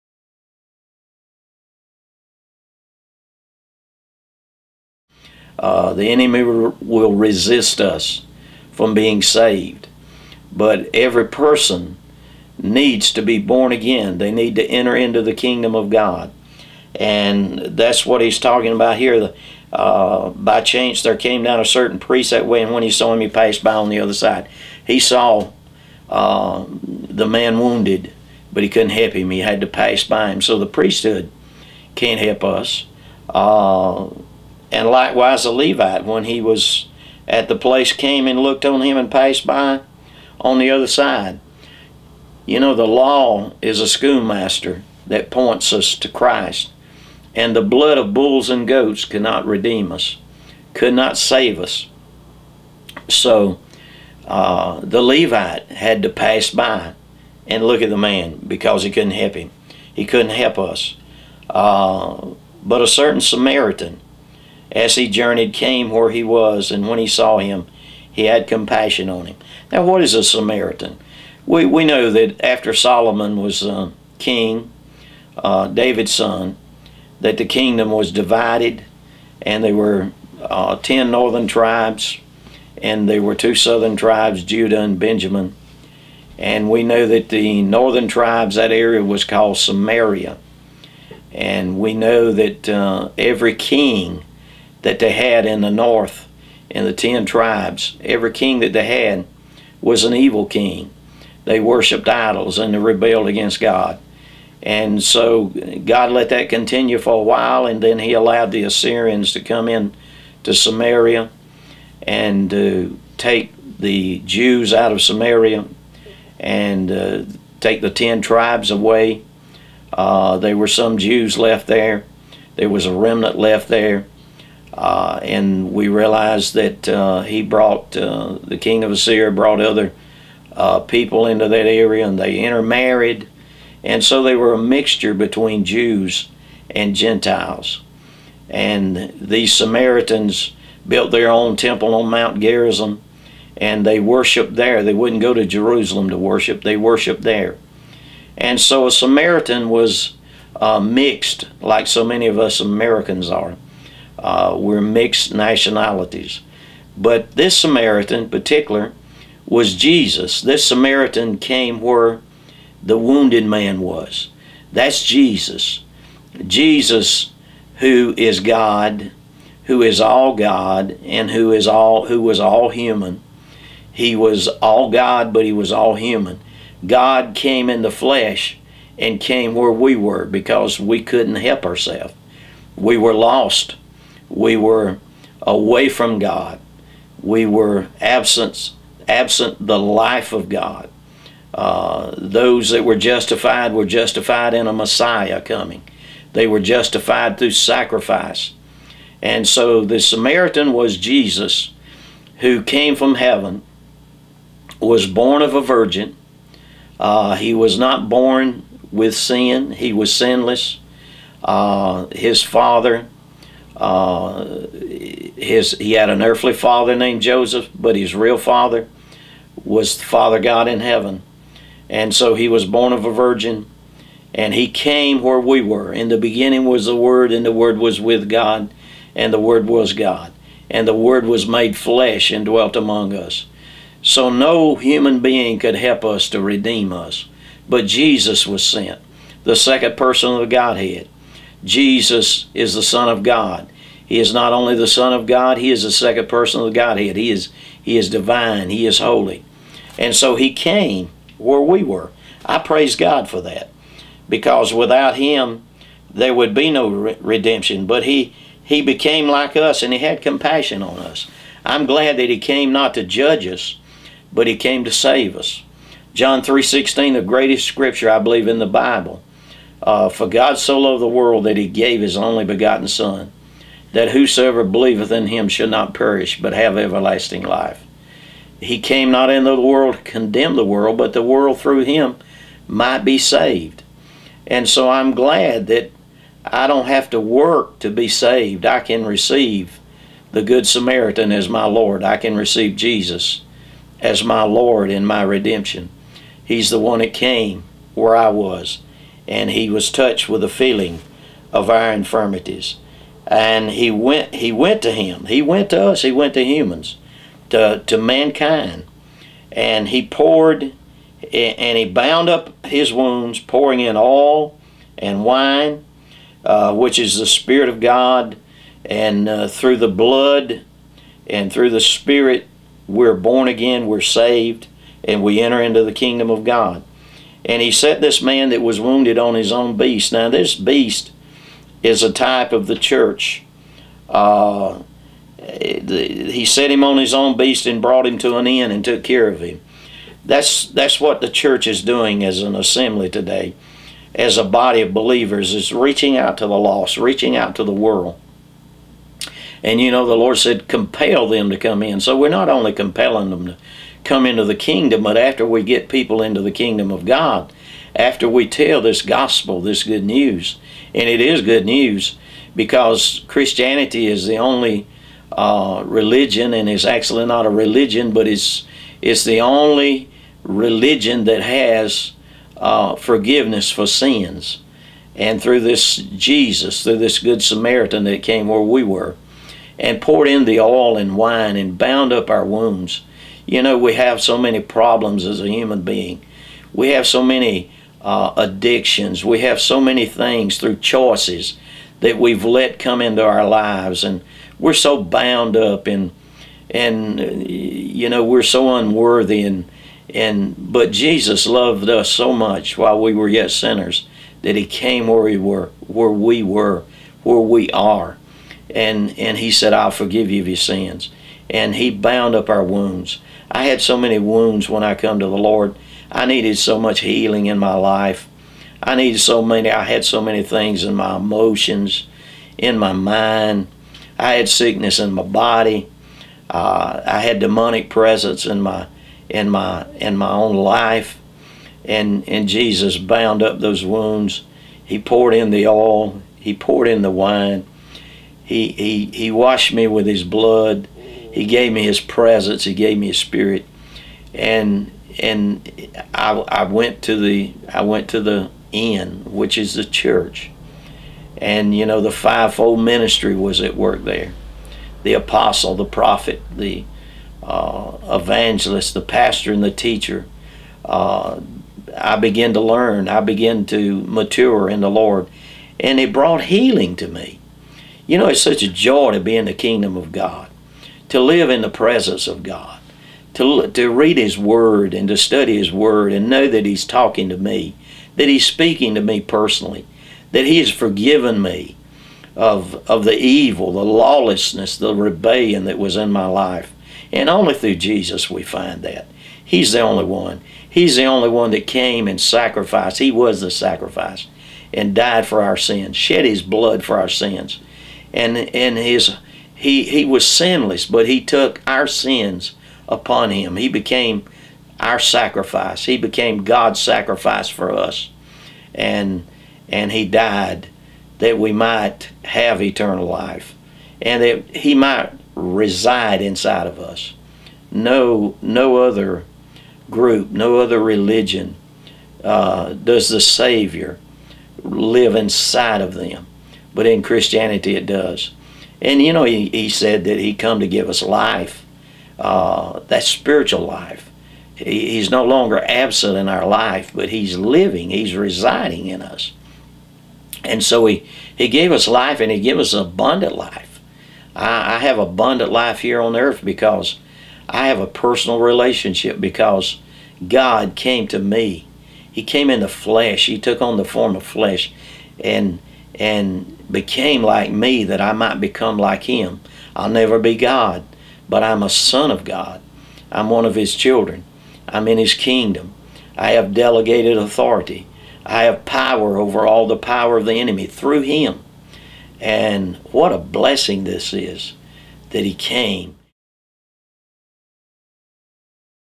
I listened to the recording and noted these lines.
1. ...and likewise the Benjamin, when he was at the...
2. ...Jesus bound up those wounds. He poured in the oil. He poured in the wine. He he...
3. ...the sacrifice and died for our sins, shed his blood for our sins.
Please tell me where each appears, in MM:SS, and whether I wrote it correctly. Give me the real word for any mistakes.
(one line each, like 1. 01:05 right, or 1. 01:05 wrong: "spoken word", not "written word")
1. 00:34 wrong: "Levite", not "Benjamin"
2. 07:12 right
3. 08:13 right.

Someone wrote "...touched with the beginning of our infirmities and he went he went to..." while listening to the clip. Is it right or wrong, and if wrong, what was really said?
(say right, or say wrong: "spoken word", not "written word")
wrong: "feeling", not "beginning".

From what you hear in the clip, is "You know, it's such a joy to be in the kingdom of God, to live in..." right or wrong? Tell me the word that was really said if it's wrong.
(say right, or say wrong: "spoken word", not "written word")
right.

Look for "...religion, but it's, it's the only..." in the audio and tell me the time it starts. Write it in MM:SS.
06:07.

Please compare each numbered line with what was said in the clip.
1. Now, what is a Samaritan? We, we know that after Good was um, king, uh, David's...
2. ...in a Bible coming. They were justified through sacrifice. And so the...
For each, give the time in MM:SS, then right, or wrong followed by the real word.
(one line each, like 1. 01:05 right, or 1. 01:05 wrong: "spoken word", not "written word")
1. 01:09 wrong: "Solomon", not "Good"
2. 03:14 wrong: "Messiah", not "Bible".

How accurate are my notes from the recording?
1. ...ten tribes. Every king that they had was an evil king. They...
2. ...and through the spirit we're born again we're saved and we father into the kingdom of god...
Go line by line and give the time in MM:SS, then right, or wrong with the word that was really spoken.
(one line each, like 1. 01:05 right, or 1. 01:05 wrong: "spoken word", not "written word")
1. 01:36 right
2. 05:21 wrong: "enter", not "father".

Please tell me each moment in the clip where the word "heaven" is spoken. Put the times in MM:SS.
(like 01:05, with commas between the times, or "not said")
03:23, 03:40.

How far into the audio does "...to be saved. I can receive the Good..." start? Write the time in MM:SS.
04:47.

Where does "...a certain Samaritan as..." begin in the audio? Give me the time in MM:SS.
01:02.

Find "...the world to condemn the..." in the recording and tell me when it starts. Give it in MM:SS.
04:39.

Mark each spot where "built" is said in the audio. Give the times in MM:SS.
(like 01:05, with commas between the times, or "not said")
02:20.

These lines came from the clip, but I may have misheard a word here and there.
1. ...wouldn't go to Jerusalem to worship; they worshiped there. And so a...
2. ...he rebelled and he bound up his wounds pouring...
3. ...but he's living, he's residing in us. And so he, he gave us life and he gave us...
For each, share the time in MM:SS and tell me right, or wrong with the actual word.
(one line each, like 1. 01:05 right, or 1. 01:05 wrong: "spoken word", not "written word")
1. 02:24 right
2. 05:09 wrong: "poured", not "rebelled"
3. 08:56 right.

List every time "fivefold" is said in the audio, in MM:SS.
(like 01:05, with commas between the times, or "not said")
07:32.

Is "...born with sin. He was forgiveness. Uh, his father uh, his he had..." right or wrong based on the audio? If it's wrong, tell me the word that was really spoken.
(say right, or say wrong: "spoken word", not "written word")
wrong: "sinless", not "forgiveness".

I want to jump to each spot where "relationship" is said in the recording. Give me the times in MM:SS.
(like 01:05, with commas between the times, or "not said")
09:08.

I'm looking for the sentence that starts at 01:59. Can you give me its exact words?
Uh, there were some Jews left there.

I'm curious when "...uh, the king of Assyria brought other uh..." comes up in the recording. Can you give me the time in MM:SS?
02:07.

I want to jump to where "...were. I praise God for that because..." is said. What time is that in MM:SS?
04:11.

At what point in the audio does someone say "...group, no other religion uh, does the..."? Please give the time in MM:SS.
08:39.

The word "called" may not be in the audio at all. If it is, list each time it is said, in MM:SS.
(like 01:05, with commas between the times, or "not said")
01:29.